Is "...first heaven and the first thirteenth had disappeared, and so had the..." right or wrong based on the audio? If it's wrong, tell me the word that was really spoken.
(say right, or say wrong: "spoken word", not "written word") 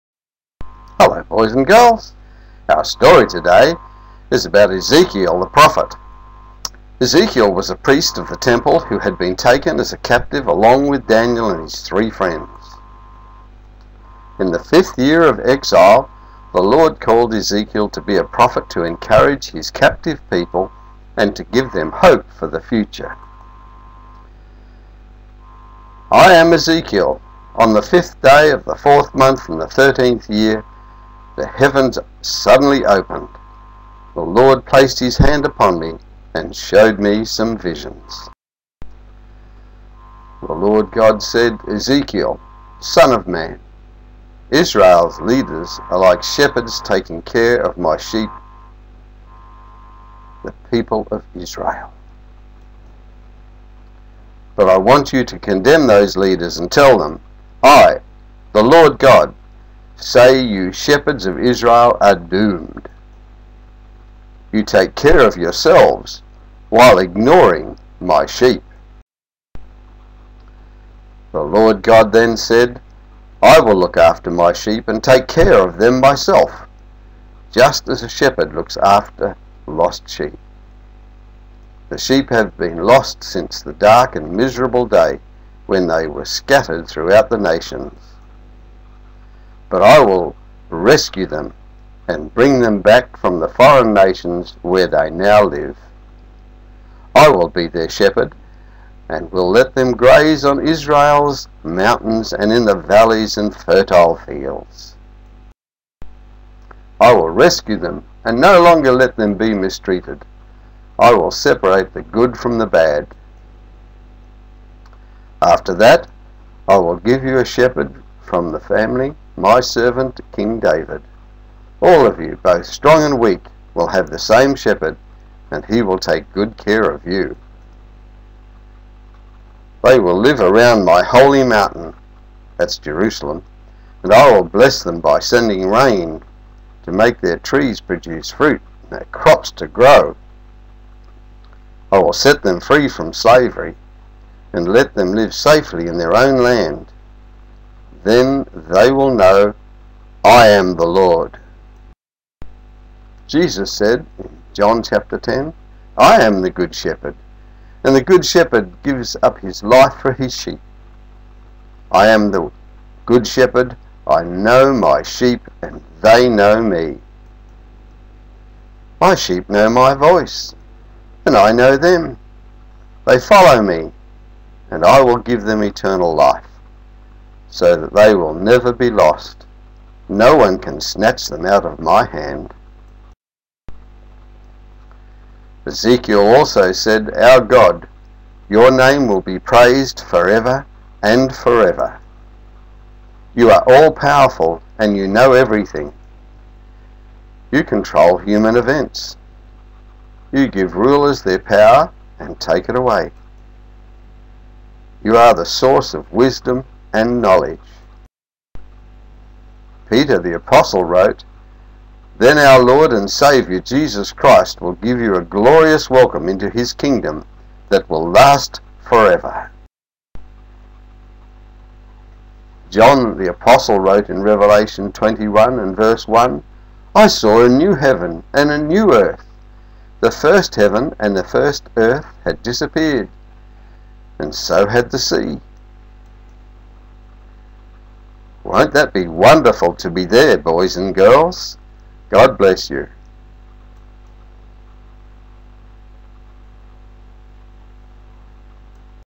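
wrong: "earth", not "thirteenth".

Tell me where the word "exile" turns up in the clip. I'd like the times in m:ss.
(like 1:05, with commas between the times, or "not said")
0:15.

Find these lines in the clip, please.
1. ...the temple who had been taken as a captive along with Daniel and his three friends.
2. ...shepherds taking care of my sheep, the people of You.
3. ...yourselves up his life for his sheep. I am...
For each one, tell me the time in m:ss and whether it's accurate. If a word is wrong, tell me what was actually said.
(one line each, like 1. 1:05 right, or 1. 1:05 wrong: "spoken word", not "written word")
1. 0:08 right
2. 0:46 wrong: "Israel", not "You"
3. 2:38 wrong: "gives", not "yourselves".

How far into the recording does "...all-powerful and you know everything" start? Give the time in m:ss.
3:13.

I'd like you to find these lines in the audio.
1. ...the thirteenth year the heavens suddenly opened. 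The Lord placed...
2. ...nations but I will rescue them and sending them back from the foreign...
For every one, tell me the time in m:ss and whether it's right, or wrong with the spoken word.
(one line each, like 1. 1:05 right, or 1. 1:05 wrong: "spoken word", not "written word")
1. 0:29 right
2. 1:27 wrong: "bring", not "sending".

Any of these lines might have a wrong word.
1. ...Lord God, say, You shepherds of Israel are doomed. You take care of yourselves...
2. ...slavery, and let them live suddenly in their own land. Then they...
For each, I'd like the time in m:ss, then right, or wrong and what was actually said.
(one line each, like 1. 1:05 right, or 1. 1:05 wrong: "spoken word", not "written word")
1. 0:58 right
2. 2:23 wrong: "safely", not "suddenly".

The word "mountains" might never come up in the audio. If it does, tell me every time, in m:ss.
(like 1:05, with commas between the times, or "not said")
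1:41, 2:11.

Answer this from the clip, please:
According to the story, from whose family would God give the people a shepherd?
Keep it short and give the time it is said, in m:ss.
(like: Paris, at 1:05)
King David, at 2:00.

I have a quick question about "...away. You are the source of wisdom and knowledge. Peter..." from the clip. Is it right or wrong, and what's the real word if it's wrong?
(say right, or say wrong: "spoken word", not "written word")
right.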